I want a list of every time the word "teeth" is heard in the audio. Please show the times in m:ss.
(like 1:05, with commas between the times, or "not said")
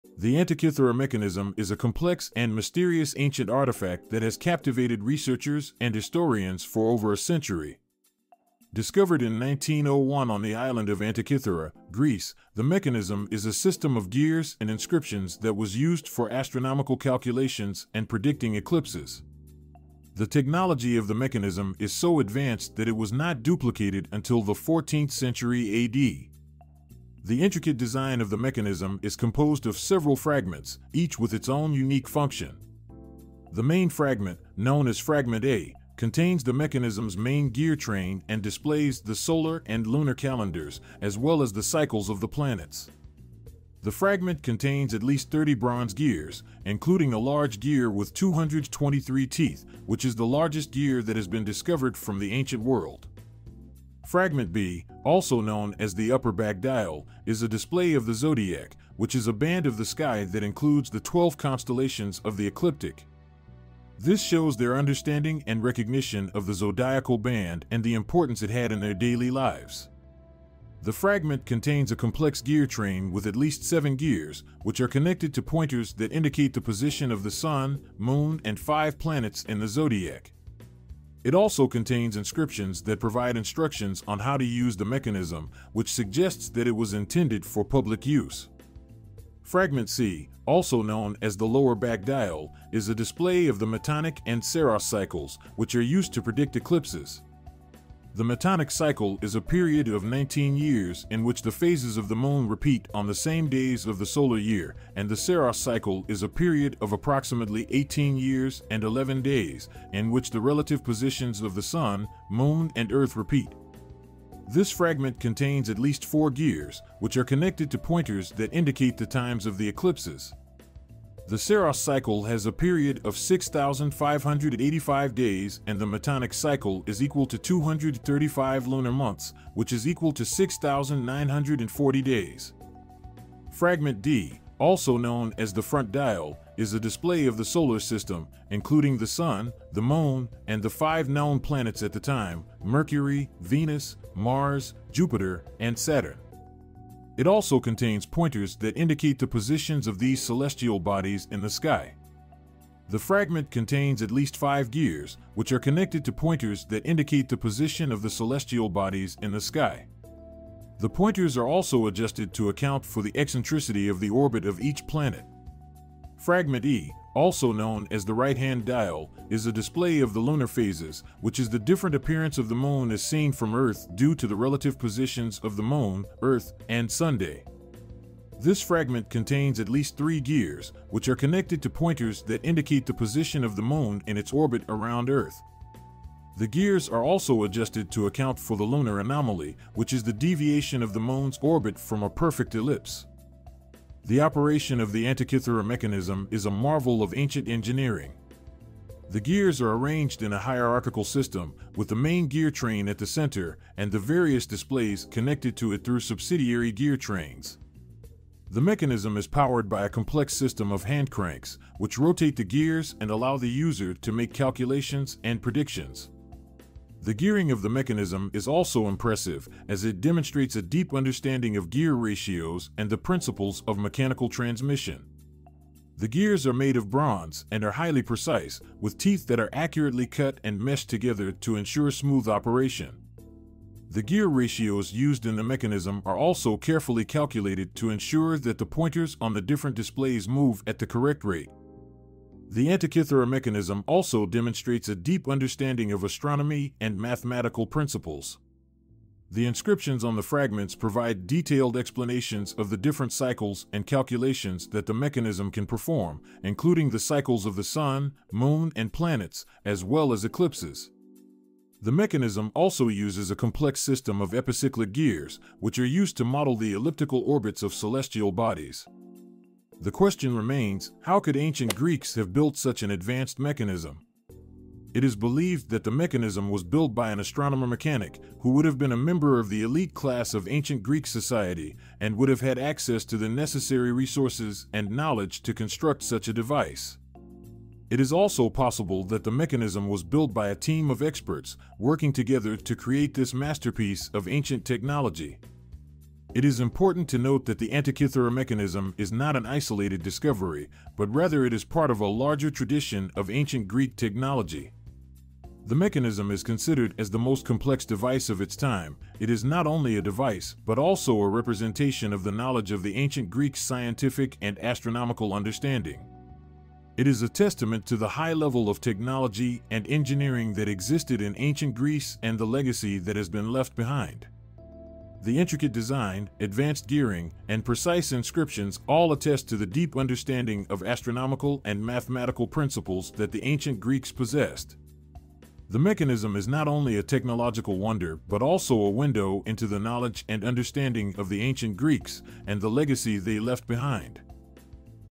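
0:49, 3:48.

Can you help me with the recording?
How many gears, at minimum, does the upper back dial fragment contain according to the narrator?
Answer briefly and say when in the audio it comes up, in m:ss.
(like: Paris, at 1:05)
7, at 1:13.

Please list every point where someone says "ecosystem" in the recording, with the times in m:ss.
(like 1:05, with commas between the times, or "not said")
not said.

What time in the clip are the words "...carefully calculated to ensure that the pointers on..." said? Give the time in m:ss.
3:56.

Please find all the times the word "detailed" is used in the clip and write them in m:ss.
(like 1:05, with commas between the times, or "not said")
4:11.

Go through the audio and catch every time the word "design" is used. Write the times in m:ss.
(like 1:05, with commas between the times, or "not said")
0:27, 5:25.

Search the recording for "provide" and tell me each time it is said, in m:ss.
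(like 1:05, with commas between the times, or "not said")
1:22, 4:10.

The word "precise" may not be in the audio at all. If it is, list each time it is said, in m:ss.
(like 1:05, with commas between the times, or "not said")
3:48, 5:27.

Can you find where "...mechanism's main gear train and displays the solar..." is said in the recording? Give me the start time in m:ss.
0:36.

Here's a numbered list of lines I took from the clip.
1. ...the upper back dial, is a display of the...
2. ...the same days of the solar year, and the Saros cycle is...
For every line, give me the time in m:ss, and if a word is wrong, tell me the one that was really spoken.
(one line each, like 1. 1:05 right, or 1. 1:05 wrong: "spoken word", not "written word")
1. 0:55 right
2. 1:43 right.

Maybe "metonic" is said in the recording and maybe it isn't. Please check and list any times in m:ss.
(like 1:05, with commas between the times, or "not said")
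1:33, 1:38, 2:05.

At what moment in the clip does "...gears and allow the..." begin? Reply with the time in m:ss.
3:32.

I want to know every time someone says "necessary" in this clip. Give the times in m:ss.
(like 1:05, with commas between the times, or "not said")
4:43.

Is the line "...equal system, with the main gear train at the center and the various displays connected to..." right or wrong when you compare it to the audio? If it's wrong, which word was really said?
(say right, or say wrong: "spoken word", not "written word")
wrong: "hierarchical", not "equal".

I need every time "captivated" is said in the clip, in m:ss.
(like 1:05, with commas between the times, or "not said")
0:04.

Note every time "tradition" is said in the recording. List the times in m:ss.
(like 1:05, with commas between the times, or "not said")
5:02.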